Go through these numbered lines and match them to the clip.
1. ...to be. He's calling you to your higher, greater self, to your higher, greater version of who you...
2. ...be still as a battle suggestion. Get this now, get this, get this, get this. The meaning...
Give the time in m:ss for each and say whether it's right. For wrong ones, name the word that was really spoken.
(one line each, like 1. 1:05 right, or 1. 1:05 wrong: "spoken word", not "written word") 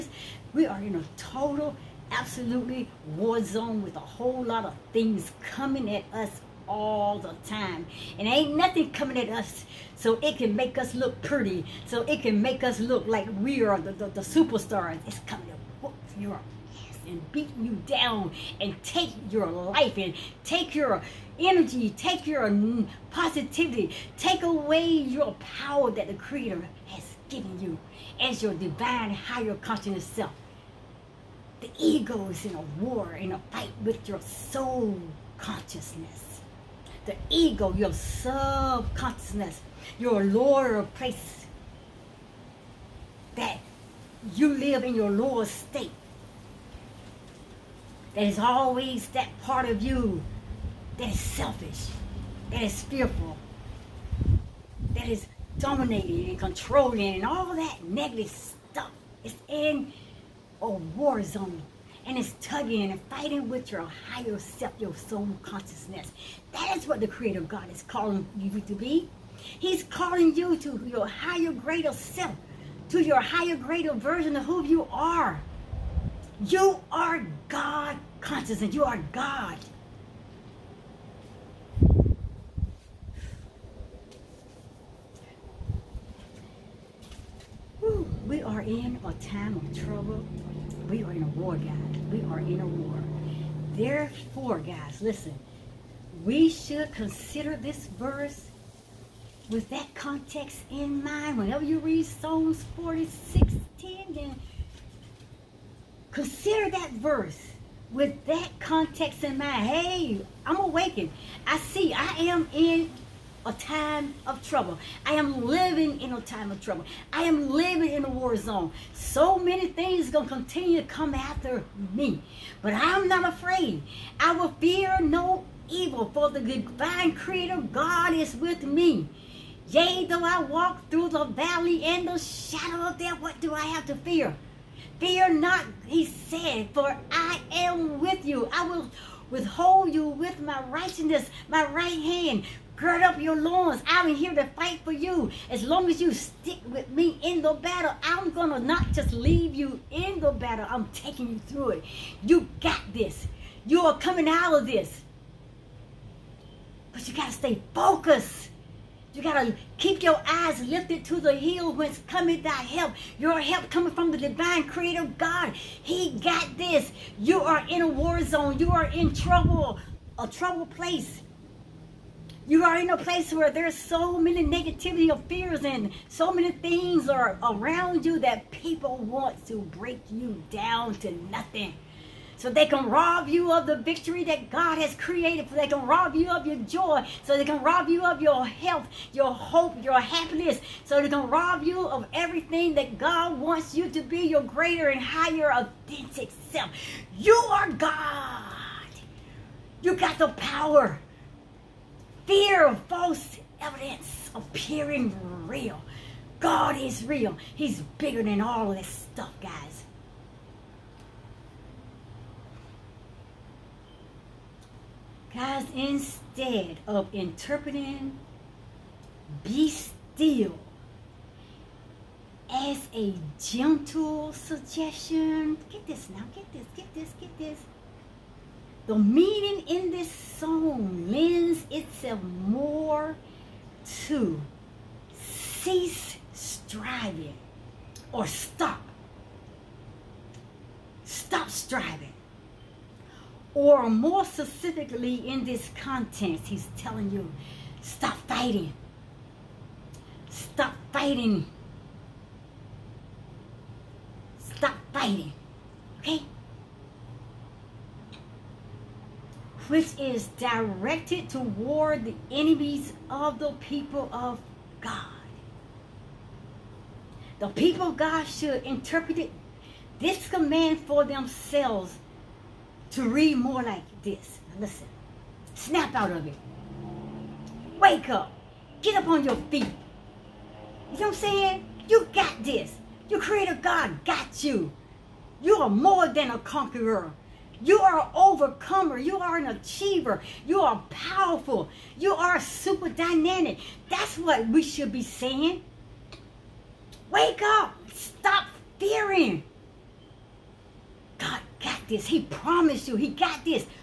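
1. 1:08 right
2. 3:39 wrong: "gentle", not "battle".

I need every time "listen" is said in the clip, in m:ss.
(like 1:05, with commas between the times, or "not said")
1:34, 4:34.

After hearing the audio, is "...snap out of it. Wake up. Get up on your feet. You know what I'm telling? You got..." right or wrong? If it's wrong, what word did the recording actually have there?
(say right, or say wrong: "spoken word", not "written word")
wrong: "saying", not "telling".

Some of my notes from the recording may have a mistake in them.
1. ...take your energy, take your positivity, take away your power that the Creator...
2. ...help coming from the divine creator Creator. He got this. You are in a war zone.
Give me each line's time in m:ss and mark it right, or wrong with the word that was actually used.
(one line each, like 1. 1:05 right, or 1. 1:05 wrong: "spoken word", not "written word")
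1. 0:20 right
2. 2:43 wrong: "God", not "Creator".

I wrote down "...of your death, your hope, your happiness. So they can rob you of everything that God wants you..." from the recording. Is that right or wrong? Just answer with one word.
wrong.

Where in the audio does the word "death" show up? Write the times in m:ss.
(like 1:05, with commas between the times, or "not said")
2:12.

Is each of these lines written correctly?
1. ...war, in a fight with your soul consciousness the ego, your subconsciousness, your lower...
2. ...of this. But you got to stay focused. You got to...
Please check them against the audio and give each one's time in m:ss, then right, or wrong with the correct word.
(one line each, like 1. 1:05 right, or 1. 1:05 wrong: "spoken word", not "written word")
1. 0:32 right
2. 2:34 right.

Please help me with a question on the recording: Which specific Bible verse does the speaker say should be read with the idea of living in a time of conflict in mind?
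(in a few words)
Psalms 46:10.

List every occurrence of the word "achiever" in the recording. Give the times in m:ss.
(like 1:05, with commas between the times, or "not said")
4:49.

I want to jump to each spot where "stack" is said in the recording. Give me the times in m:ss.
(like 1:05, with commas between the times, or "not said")
not said.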